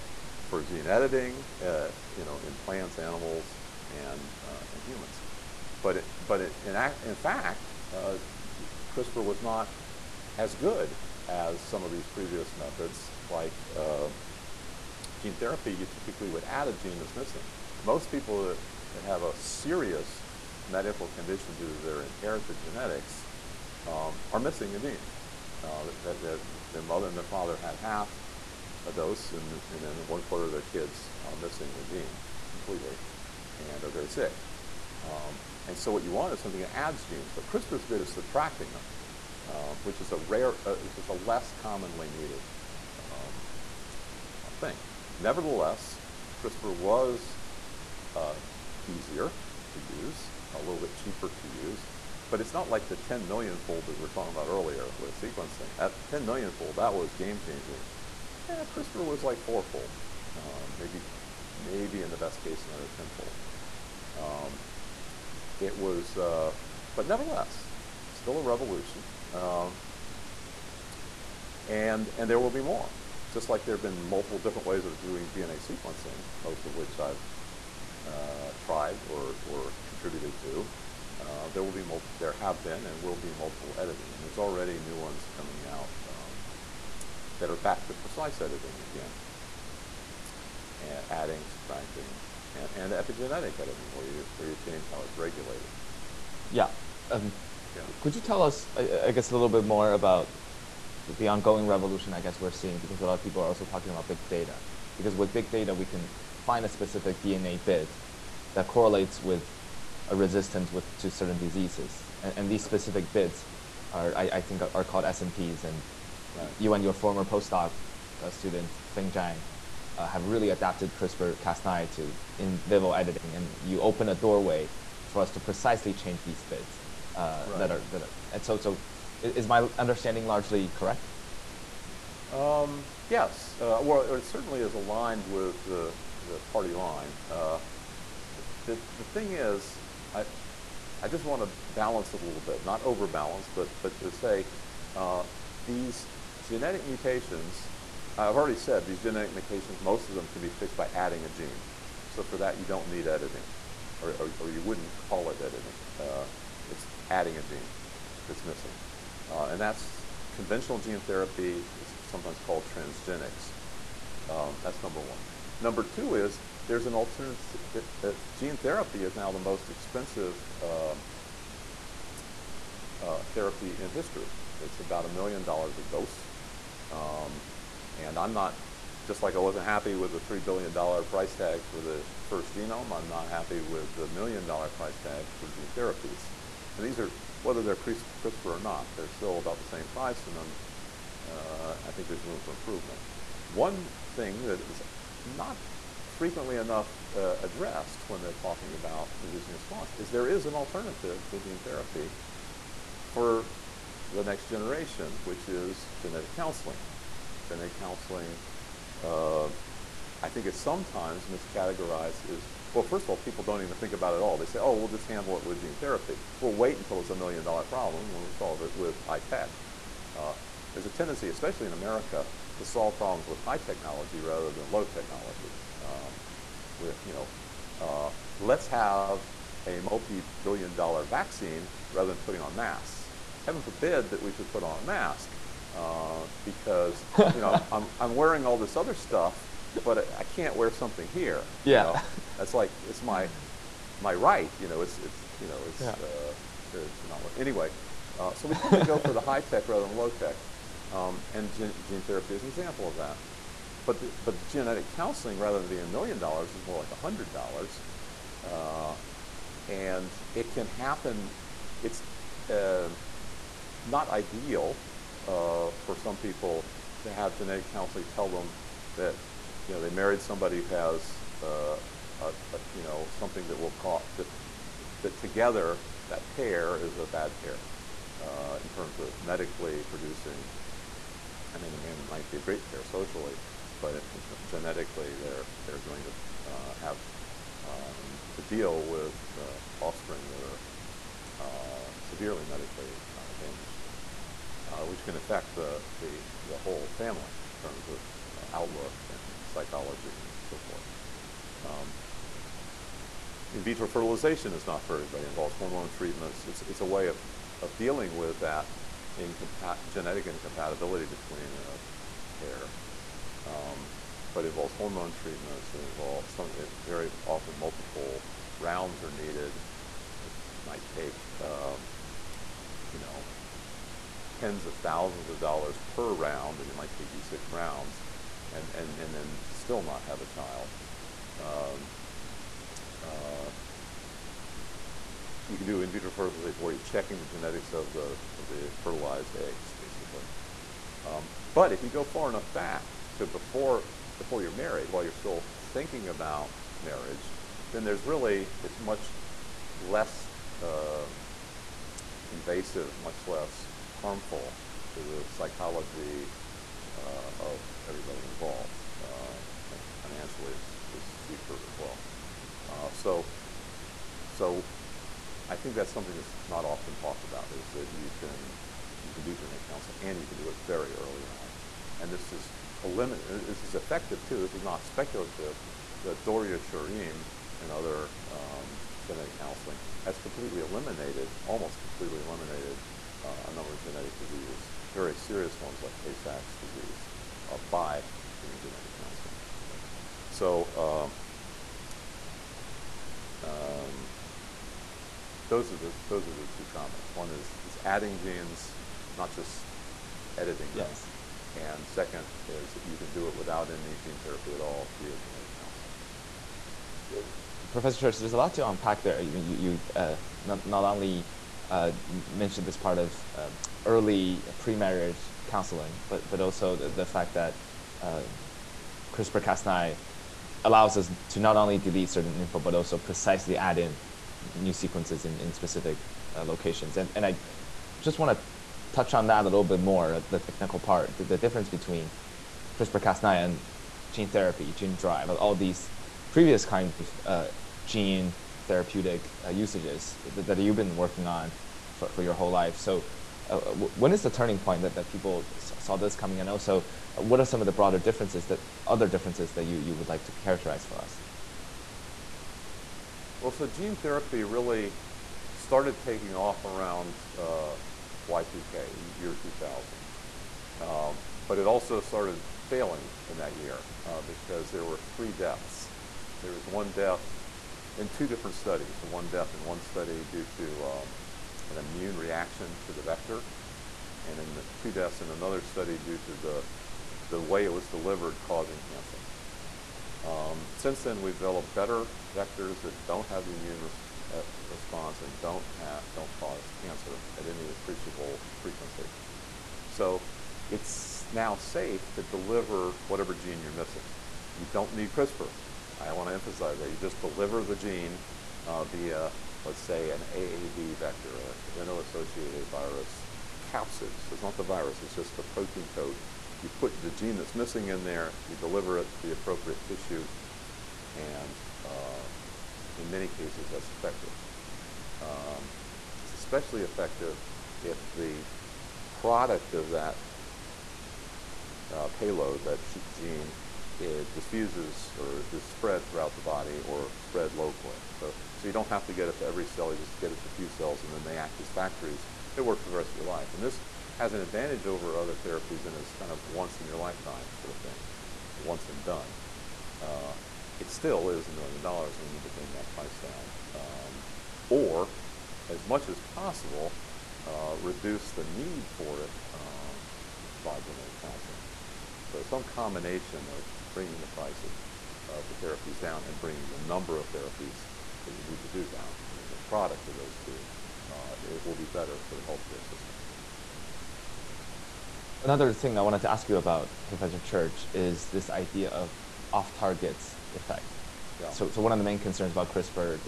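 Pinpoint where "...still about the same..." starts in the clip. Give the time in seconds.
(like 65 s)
189 s.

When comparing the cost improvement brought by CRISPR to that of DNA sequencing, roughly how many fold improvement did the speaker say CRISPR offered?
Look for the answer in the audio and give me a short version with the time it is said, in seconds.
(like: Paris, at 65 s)
fourfold, at 59 s.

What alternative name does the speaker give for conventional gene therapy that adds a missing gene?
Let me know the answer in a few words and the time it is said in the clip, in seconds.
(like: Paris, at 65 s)
transgenics, at 162 s.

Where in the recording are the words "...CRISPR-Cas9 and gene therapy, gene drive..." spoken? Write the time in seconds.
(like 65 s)
432 s.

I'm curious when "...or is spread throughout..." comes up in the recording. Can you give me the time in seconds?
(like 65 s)
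525 s.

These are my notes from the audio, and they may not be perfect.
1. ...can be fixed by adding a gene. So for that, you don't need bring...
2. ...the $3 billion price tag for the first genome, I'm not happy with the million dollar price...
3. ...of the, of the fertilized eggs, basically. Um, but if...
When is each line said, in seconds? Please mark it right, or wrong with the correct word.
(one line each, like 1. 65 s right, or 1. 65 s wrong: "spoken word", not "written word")
1. 150 s wrong: "editing", not "bring"
2. 180 s right
3. 337 s right.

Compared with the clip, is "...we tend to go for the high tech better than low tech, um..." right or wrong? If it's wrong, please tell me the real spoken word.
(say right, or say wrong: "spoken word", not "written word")
wrong: "rather", not "better".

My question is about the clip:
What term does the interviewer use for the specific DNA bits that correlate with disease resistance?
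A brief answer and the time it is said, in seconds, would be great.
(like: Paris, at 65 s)
SNPs, at 115 s.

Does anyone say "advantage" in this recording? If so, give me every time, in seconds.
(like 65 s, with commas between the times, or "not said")
534 s.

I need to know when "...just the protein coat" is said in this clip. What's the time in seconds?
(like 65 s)
505 s.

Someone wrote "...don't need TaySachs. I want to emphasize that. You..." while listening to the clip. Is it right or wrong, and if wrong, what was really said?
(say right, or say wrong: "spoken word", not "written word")
wrong: "CRISPR", not "TaySachs".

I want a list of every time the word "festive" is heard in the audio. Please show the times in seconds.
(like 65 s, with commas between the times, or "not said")
not said.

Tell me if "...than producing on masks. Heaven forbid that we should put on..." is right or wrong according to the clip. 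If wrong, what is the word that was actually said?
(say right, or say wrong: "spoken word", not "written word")
wrong: "putting", not "producing".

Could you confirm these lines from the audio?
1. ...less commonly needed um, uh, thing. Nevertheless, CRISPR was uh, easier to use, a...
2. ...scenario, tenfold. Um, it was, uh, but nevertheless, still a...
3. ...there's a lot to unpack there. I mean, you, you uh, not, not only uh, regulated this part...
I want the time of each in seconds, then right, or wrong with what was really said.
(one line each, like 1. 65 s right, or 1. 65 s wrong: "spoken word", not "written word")
1. 41 s right
2. 62 s right
3. 408 s wrong: "mentioned", not "regulated".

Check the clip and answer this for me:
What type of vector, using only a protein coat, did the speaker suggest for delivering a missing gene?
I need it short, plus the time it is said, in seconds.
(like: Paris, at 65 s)
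AAV vector, at 500 s.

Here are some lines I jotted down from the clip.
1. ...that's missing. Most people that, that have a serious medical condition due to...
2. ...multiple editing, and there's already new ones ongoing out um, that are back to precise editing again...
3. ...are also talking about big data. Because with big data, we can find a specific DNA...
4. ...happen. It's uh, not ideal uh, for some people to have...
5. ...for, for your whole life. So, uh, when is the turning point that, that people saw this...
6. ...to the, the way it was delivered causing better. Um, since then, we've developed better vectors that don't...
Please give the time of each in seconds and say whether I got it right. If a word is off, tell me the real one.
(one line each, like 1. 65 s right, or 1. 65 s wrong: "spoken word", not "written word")
1. 16 s right
2. 83 s wrong: "coming", not "ongoing"
3. 103 s right
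4. 260 s right
5. 441 s right
6. 476 s wrong: "cancer", not "better".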